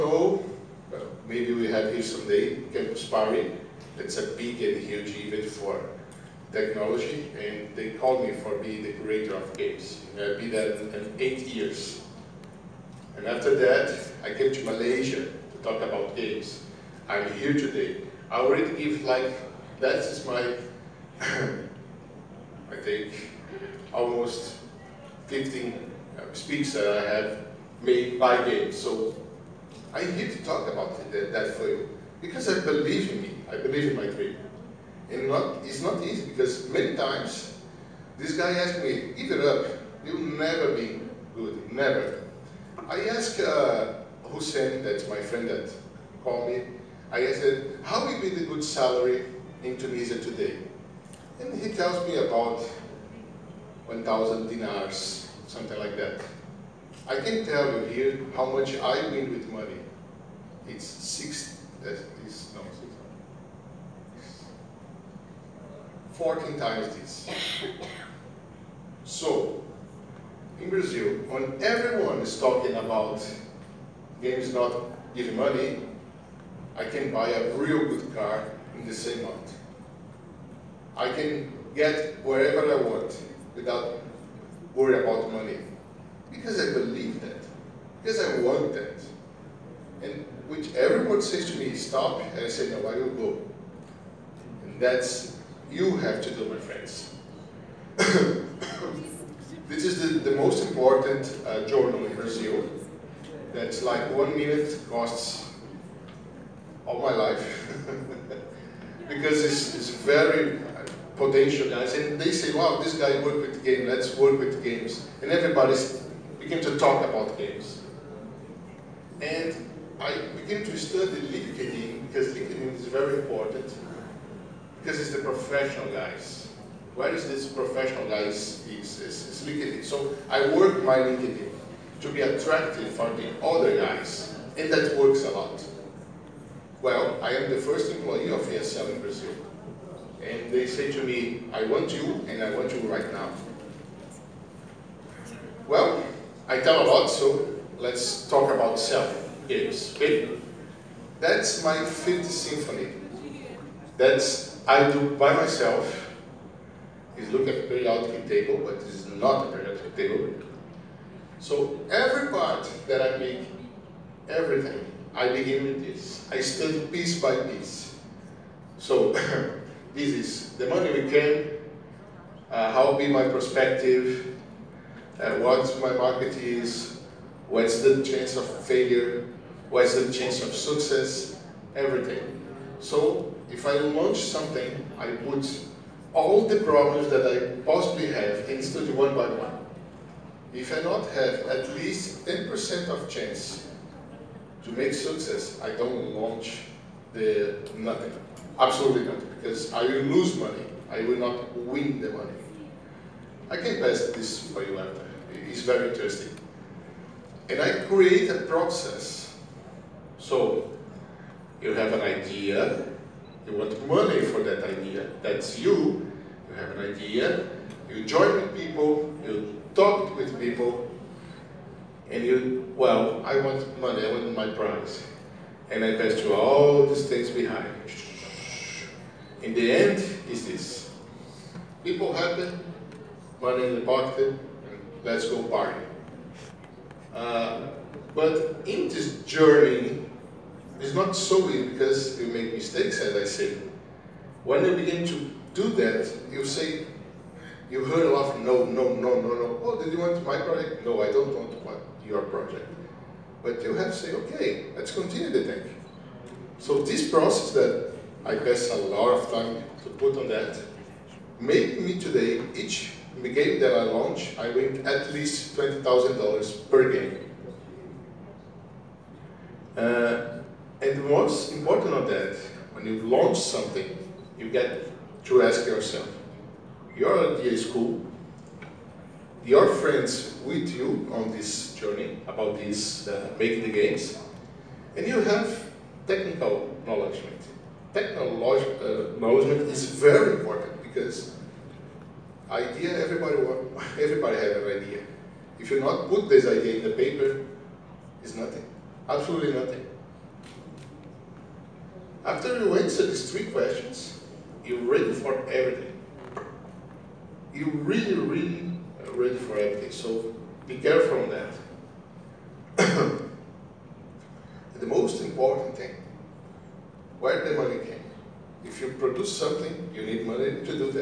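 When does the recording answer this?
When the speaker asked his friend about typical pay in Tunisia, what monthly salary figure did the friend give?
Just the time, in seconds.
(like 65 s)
53 s.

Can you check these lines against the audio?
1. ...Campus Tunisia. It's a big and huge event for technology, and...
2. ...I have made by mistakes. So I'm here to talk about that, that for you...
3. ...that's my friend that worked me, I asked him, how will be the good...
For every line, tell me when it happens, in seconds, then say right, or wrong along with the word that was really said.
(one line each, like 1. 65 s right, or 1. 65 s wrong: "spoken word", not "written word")
1. 2 s wrong: "Party", not "Tunisia"
2. 26 s wrong: "games", not "mistakes"
3. 44 s wrong: "called", not "worked".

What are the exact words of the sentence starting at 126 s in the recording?
Where is this professional guys' is, is, is, LinkedIn.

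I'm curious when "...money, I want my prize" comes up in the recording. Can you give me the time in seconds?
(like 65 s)
223 s.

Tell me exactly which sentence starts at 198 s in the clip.
Absolutely not, because I will lose money.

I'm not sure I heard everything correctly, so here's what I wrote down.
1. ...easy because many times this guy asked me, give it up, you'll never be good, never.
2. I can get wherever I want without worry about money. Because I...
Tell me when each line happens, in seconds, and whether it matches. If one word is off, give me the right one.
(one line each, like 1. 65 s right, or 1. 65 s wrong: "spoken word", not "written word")
1. 36 s right
2. 80 s right.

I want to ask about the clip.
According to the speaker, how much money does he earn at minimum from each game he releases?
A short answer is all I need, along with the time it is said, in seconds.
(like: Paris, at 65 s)
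$20,000, at 265 s.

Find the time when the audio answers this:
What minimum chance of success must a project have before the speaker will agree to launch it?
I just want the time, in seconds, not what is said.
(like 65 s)
192 s.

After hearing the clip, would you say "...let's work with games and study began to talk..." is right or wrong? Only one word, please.
wrong.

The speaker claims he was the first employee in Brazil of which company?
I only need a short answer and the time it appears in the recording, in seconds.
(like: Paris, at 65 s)
ESL, at 138 s.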